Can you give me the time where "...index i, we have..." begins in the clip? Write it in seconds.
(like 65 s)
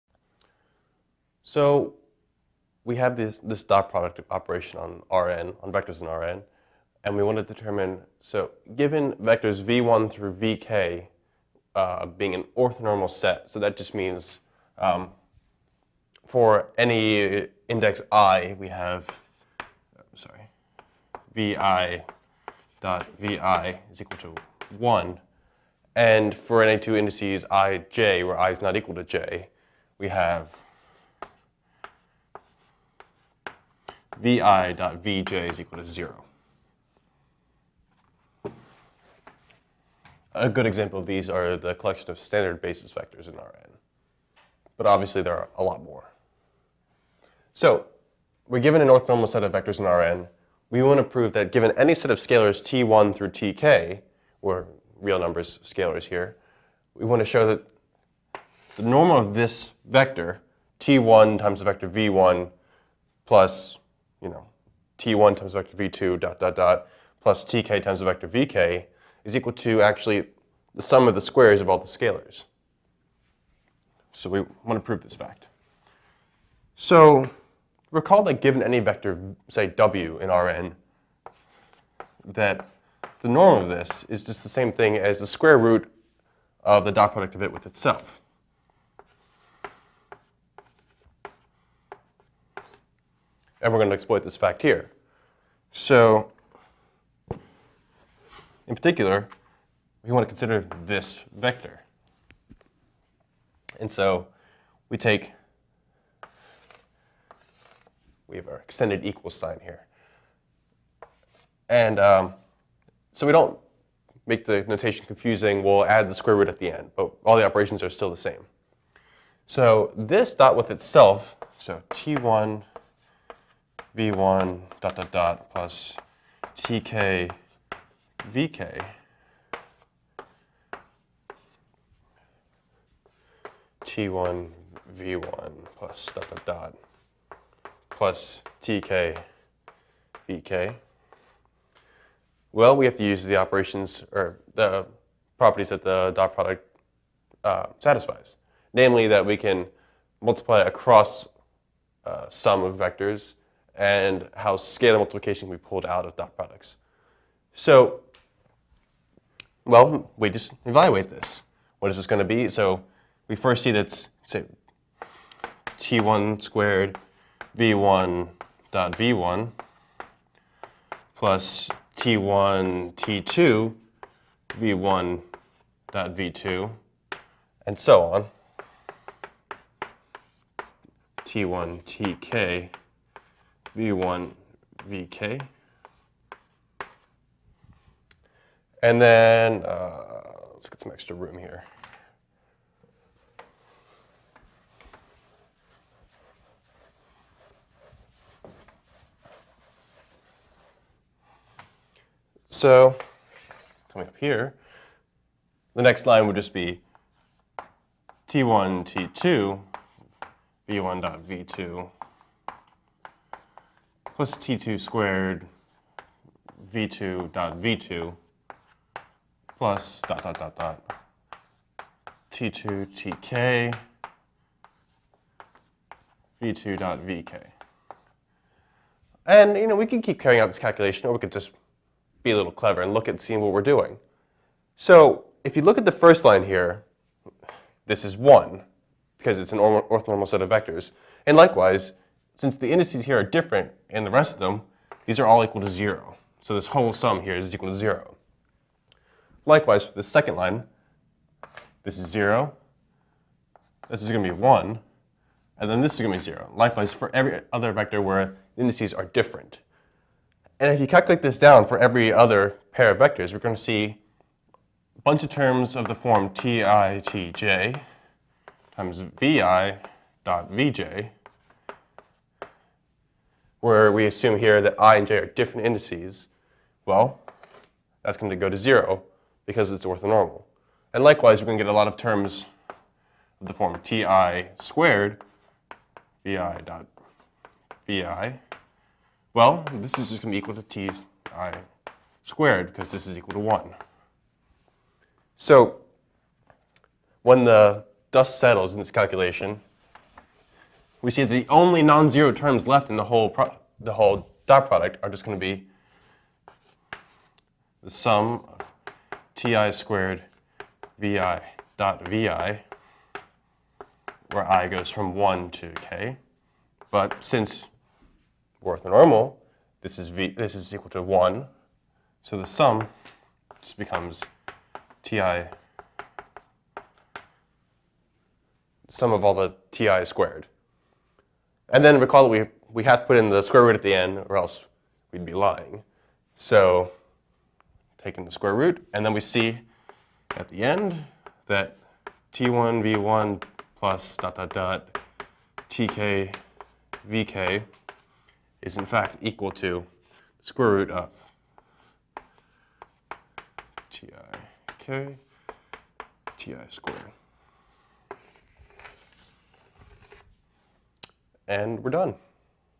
17 s.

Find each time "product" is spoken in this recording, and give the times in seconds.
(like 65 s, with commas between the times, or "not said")
3 s, 87 s, 146 s, 156 s, 304 s.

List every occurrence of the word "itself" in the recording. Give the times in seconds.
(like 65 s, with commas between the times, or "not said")
87 s, 120 s.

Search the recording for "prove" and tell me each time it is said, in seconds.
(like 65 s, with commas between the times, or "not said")
51 s, 74 s.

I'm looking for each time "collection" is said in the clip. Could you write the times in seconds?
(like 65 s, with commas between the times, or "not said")
41 s.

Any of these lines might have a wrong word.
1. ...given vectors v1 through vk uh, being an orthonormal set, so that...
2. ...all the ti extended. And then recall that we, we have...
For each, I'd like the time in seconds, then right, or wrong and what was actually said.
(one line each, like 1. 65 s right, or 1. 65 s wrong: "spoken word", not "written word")
1. 8 s right
2. 329 s wrong: "squared", not "extended".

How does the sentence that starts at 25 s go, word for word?
And for any two indices ij, where i is not equal to j, we have vi dot vj is equal to 0.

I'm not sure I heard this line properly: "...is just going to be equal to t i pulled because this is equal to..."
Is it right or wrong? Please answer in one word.
wrong.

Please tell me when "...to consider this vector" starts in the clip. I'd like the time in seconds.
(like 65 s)
100 s.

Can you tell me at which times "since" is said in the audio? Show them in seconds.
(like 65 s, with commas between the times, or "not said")
242 s, 317 s.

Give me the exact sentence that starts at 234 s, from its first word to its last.
So if you look at the first line here, this is 1 because it's an orthonormal set of vectors.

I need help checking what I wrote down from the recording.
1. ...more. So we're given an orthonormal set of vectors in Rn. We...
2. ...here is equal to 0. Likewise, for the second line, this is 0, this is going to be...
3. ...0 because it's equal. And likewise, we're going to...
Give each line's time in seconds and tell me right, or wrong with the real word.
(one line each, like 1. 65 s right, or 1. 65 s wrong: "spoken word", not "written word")
1. 45 s right
2. 247 s right
3. 278 s wrong: "orthonormal", not "equal".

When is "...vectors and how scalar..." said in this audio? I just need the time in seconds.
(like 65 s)
152 s.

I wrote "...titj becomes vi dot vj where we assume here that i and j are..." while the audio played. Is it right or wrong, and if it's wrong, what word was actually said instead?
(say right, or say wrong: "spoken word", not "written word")
wrong: "times", not "becomes".